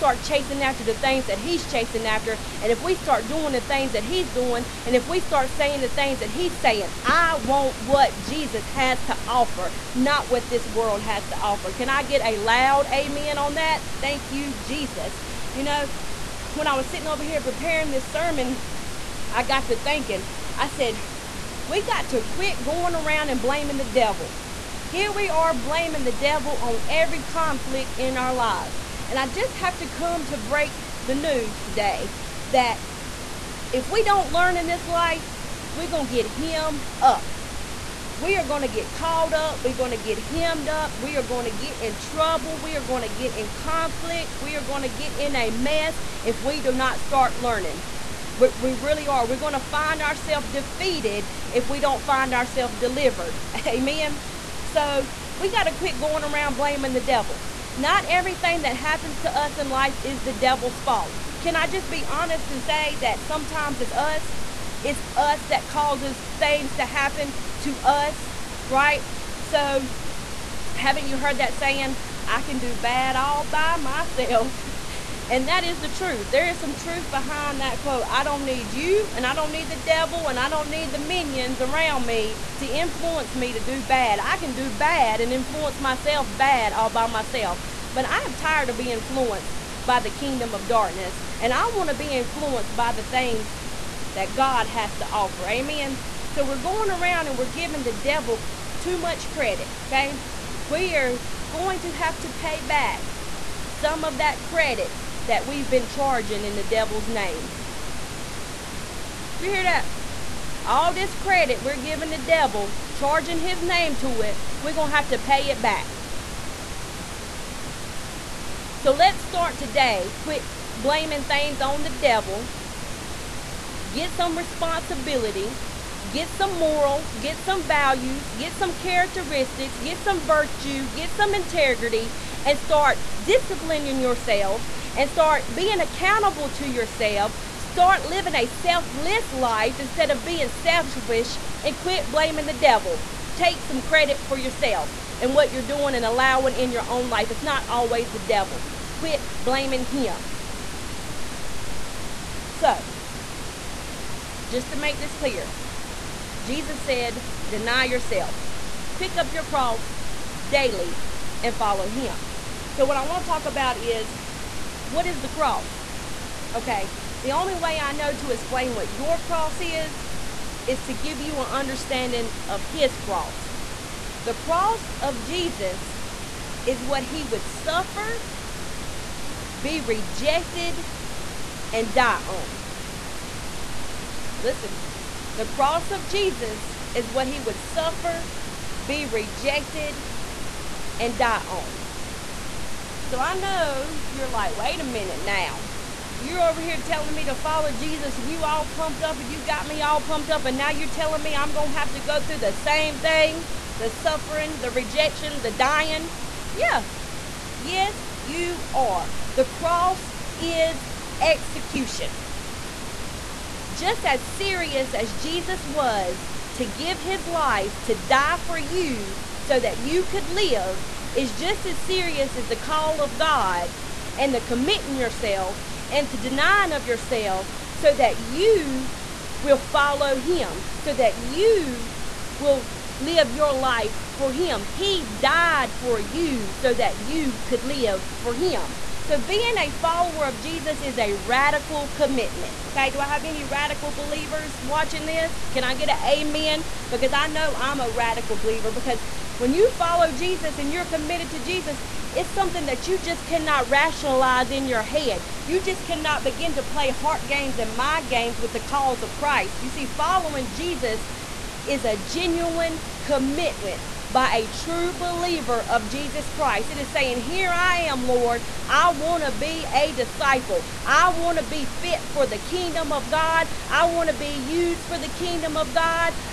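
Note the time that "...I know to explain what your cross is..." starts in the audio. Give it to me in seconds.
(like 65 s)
167 s.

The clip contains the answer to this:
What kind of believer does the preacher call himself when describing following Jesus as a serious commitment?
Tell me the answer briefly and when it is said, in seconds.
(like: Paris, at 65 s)
radical believer, at 247 s.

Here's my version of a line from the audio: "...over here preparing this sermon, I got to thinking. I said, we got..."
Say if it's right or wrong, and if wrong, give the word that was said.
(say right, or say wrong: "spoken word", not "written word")
right.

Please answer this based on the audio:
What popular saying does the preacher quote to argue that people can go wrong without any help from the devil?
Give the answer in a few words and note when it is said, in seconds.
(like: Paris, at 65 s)
I can do bad all by myself, at 72 s.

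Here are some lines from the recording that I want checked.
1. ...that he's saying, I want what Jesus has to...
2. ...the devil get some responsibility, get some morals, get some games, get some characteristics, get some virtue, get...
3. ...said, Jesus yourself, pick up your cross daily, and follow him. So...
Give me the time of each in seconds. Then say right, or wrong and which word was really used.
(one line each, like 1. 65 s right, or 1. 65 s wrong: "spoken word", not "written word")
1. 6 s right
2. 121 s wrong: "values", not "games"
3. 156 s wrong: "Deny", not "Jesus".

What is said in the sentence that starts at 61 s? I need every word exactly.
Can I just be honest and say that sometimes it's us?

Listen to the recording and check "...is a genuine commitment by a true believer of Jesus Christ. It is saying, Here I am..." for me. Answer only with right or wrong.
right.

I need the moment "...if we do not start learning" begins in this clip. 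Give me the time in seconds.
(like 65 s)
46 s.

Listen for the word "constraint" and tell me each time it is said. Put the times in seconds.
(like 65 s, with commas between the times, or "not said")
not said.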